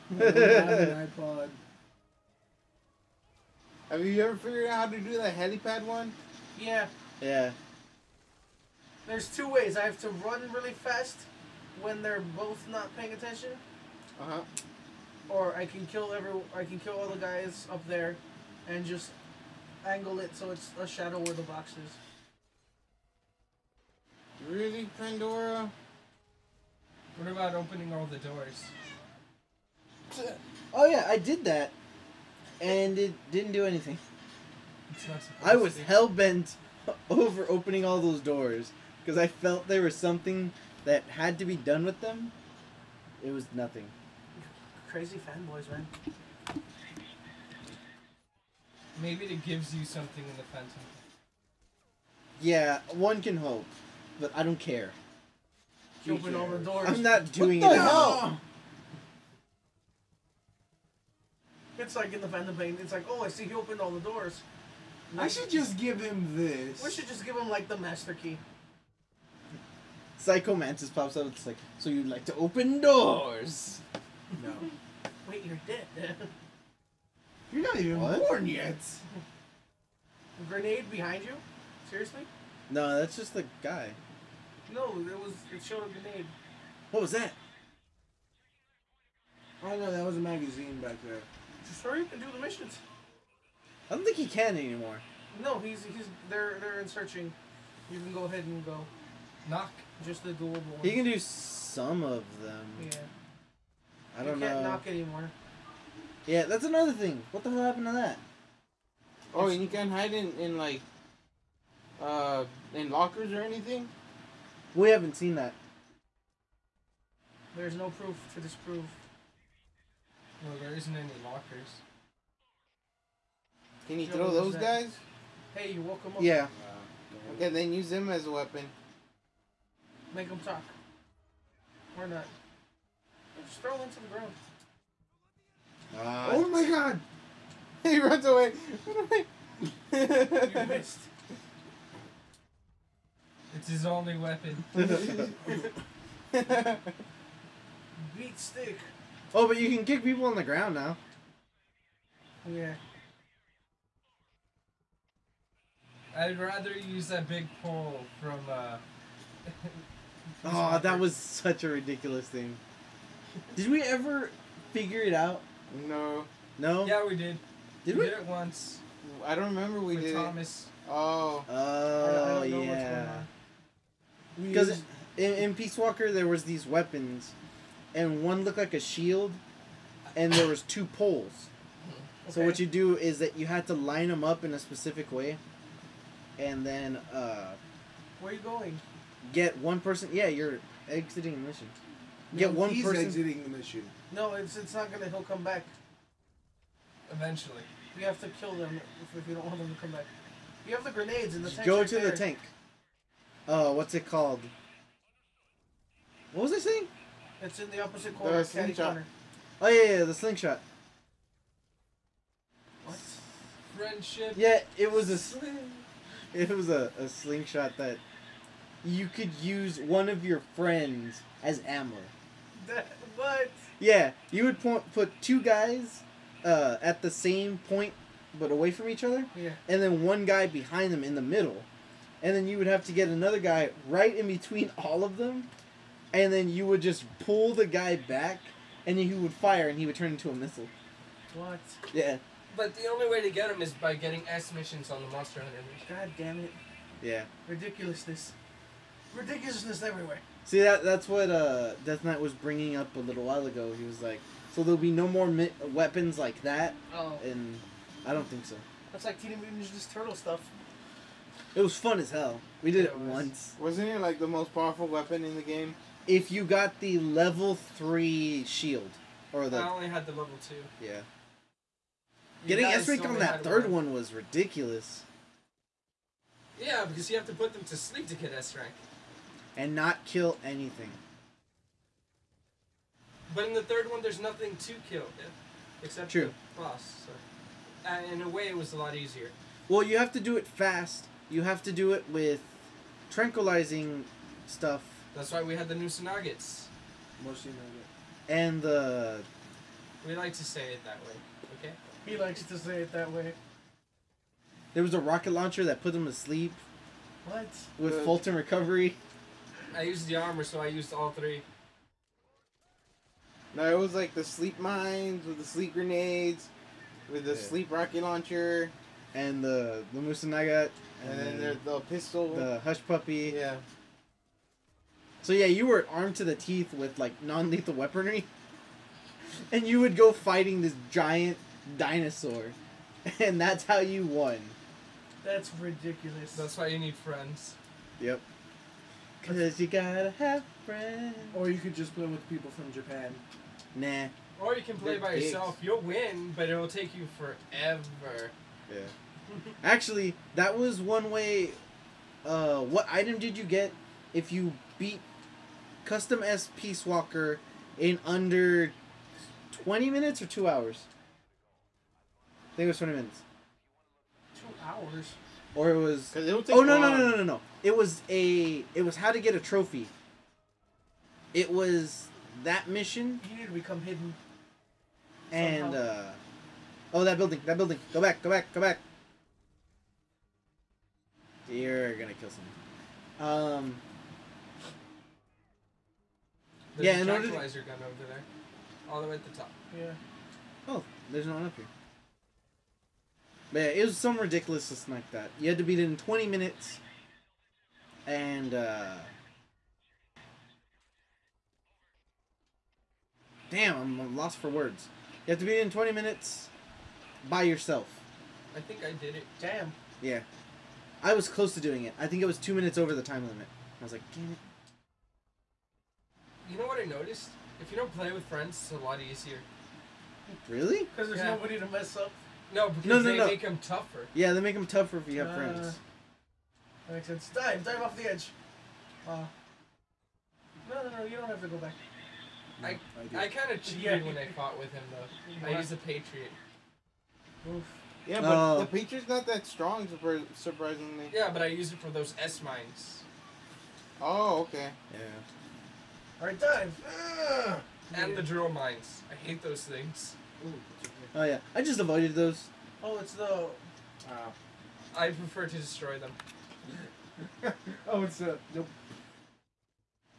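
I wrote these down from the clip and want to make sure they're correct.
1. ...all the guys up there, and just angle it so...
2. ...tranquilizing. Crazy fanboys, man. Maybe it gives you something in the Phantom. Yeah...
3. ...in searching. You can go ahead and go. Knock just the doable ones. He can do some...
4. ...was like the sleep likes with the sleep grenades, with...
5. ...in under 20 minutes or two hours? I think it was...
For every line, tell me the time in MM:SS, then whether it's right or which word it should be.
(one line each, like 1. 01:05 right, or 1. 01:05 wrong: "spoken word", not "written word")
1. 00:16 right
2. 00:43 wrong: "nothing", not "tranquilizing"
3. 01:36 right
4. 05:13 wrong: "mines", not "likes"
5. 05:57 right.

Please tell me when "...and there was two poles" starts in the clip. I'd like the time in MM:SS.
03:00.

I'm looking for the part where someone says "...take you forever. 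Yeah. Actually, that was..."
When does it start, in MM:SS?
05:46.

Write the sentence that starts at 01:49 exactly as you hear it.
Oh, and you can hide in, in like uh in lockers or anything?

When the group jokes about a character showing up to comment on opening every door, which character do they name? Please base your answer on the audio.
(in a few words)
Psycho Mantis.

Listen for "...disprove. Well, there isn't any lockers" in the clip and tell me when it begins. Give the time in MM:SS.
01:58.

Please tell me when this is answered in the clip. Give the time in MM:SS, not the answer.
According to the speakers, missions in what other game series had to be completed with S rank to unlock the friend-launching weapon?
04:05.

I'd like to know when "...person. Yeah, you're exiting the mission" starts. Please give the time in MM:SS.
03:09.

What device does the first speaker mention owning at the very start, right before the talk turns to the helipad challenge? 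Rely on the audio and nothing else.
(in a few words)
iPod.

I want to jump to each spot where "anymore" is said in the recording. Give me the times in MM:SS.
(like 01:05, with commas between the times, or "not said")
01:34, 01:44.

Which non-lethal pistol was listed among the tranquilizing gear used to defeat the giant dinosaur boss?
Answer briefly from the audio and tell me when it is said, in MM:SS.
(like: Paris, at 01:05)
The hush puppy, at 05:22.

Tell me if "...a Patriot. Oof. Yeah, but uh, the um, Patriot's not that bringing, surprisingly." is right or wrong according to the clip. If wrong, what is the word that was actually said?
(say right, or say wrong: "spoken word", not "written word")
wrong: "strong", not "bringing".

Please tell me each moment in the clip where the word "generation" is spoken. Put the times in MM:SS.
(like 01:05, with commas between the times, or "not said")
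not said.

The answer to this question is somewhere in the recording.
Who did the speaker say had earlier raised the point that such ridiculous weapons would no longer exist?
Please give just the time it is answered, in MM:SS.
04:11.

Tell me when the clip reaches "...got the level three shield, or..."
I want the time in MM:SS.
04:26.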